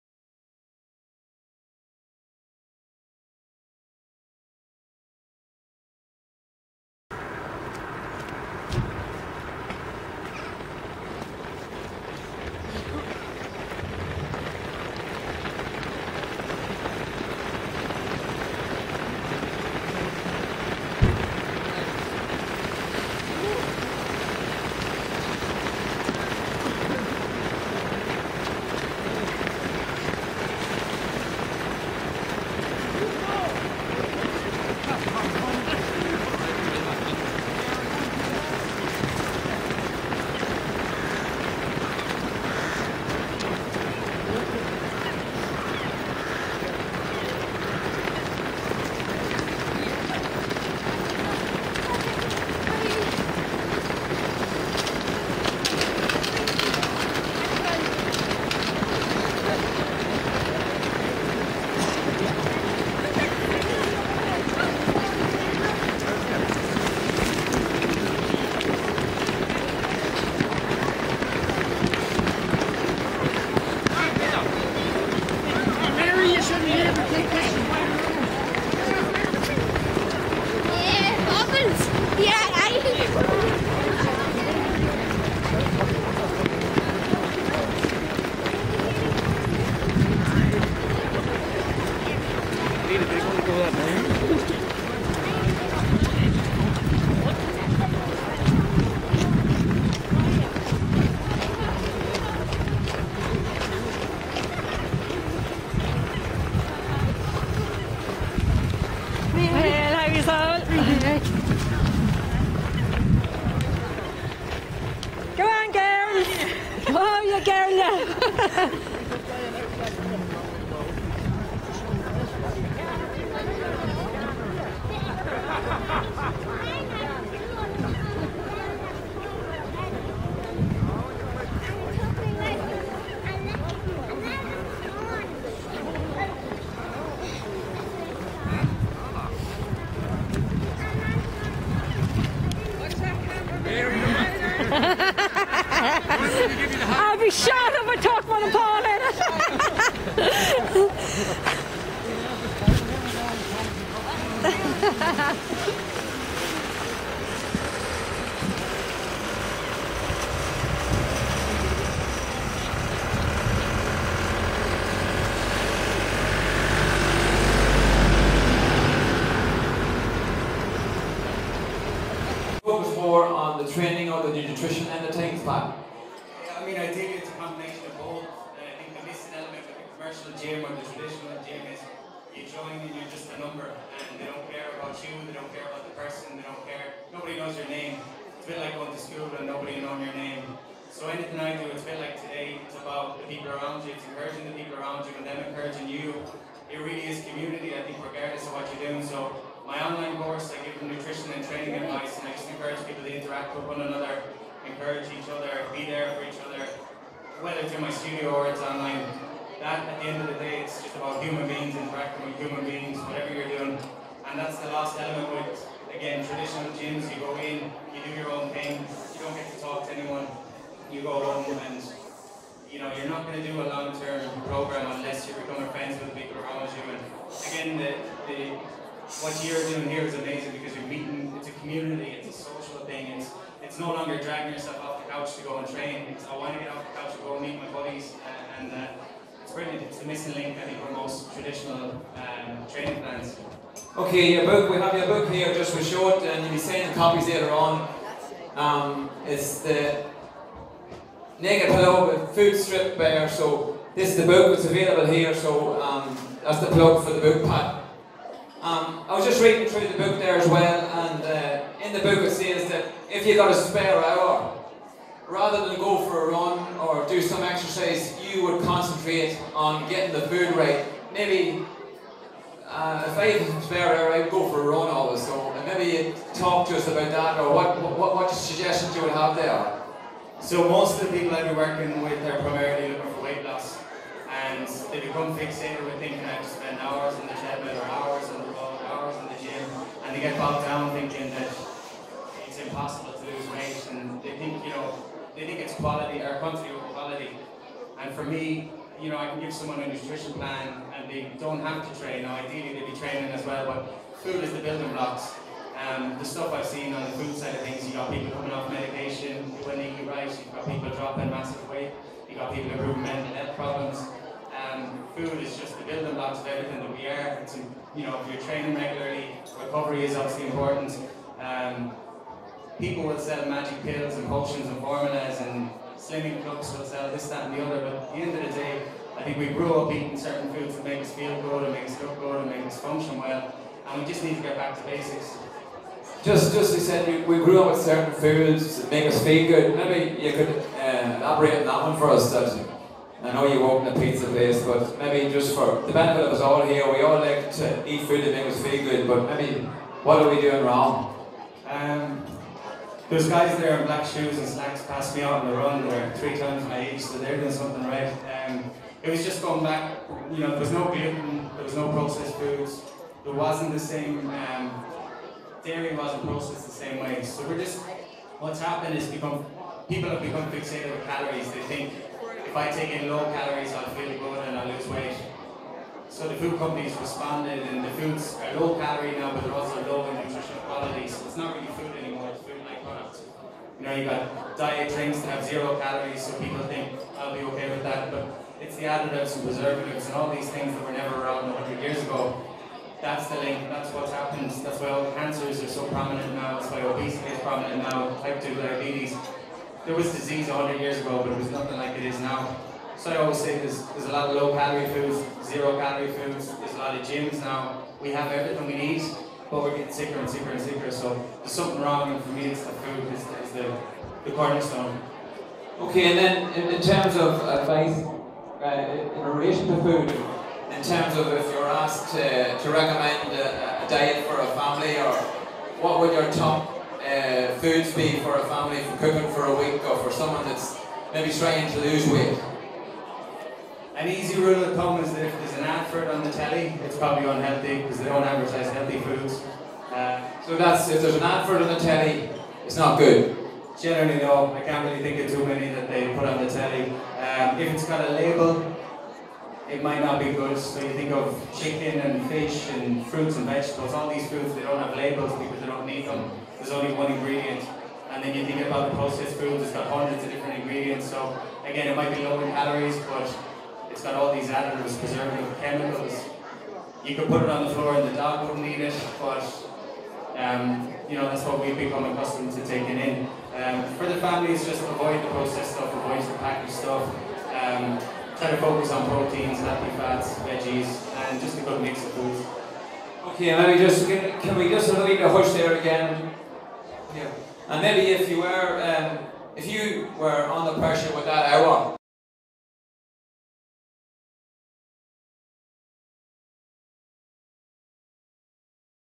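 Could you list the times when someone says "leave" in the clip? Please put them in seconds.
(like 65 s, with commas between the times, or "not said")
484 s.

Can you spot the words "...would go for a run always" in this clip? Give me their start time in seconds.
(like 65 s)
274 s.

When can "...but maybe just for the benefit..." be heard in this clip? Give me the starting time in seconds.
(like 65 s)
344 s.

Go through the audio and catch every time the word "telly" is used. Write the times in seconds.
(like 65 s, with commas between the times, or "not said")
436 s, 441 s, 446 s.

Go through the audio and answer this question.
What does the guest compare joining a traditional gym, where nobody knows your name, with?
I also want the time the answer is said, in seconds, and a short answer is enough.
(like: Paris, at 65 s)
Going to school, at 188 s.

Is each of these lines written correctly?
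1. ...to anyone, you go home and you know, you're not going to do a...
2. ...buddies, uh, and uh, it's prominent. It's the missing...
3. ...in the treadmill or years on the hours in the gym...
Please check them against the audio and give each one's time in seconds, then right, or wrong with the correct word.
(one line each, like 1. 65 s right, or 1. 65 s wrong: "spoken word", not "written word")
1. 219 s right
2. 237 s wrong: "brilliant", not "prominent"
3. 287 s wrong: "hours", not "years".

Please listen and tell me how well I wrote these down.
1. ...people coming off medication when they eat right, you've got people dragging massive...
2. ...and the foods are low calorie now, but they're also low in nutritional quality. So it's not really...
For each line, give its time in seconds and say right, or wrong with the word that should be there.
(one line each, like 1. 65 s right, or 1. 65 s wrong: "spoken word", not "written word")
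1. 308 s wrong: "dropping", not "dragging"
2. 377 s right.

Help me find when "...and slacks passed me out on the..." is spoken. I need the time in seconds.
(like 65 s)
354 s.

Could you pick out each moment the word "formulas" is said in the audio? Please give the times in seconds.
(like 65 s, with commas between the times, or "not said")
324 s.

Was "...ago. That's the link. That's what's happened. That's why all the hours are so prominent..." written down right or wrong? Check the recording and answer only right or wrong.
wrong.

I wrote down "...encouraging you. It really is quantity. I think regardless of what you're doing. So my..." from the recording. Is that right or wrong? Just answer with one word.
wrong.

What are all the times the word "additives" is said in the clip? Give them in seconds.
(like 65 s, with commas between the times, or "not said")
388 s, 464 s.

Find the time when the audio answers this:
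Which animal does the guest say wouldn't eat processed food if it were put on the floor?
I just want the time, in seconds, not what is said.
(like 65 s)
468 s.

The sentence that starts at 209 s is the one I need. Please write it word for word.
That, at the end of the day, it's just about human beings interacting with human beings, whatever you're doing.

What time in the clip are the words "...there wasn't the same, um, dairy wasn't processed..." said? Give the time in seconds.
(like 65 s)
363 s.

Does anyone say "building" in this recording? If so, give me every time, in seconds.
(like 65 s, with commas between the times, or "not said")
304 s, 315 s.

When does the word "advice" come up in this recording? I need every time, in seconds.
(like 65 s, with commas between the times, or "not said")
201 s, 417 s.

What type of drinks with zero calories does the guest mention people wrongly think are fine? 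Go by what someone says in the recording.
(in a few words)
Diet drinks.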